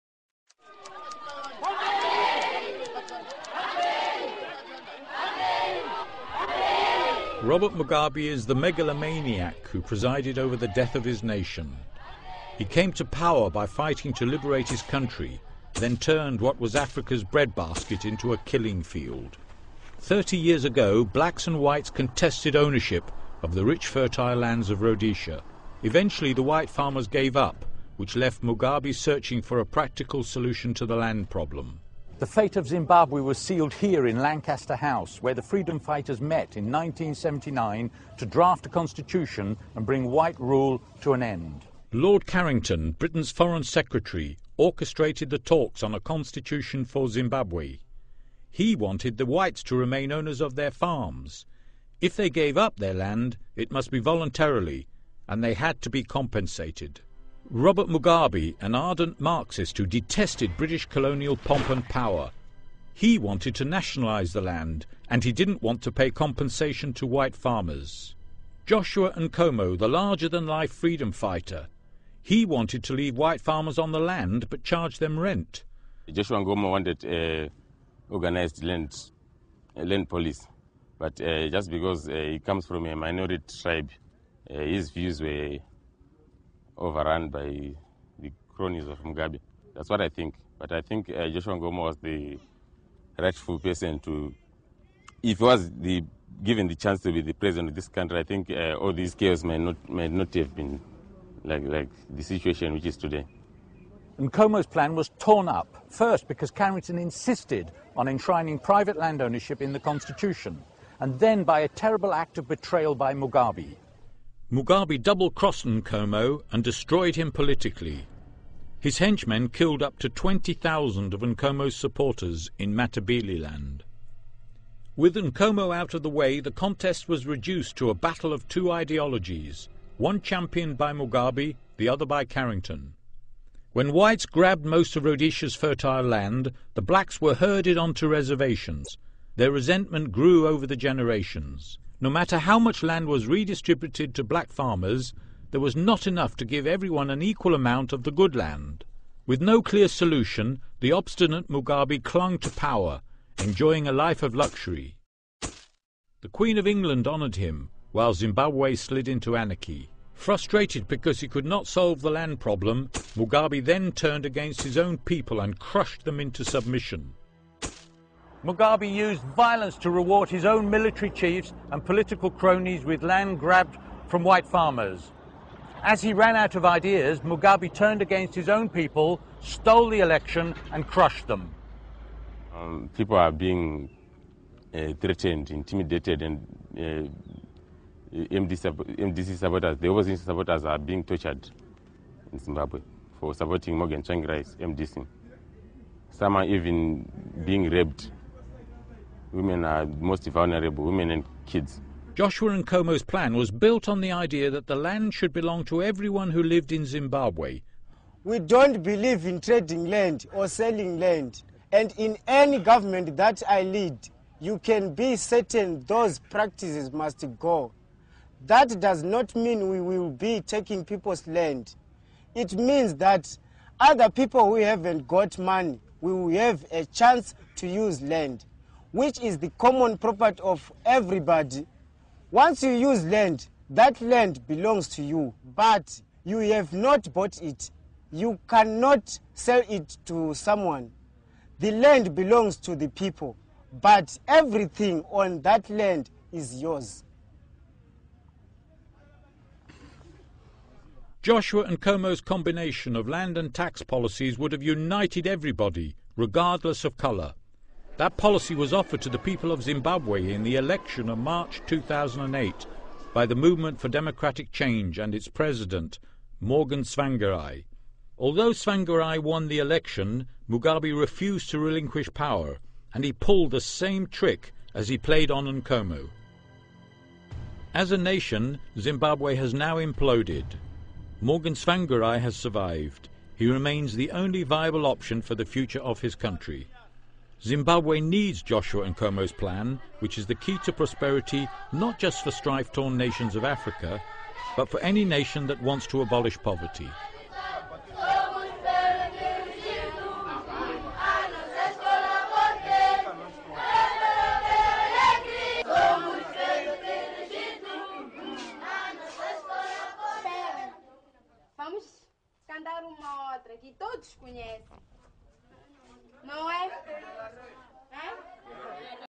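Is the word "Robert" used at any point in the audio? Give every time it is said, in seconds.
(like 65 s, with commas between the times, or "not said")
7 s, 57 s.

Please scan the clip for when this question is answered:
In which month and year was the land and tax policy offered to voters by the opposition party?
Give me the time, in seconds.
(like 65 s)
261 s.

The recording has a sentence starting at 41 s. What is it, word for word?
Lord Carrington, Britain's Foreign Secretary, orchestrated the talks on a constitution for Zimbabwe.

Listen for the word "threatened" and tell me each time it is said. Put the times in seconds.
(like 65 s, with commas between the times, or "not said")
184 s.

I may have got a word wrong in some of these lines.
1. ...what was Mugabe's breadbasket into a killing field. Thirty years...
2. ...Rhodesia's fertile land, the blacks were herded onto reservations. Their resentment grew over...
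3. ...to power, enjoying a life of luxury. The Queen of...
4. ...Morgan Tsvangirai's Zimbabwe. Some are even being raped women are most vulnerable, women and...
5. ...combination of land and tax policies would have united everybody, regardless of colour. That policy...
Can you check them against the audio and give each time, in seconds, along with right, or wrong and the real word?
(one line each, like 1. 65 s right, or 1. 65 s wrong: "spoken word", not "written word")
1. 16 s wrong: "Africa", not "Mugabe"
2. 135 s right
3. 152 s right
4. 193 s wrong: "MDC", not "Zimbabwe"
5. 252 s right.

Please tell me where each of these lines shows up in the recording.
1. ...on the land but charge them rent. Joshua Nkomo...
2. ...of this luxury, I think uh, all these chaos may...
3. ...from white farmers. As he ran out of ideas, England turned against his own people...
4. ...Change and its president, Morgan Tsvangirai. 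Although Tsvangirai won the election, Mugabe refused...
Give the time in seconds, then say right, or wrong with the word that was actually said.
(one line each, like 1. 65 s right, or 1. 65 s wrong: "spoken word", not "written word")
1. 73 s right
2. 97 s wrong: "country", not "luxury"
3. 174 s wrong: "Mugabe", not "England"
4. 264 s right.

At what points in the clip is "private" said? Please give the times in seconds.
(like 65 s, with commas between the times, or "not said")
108 s.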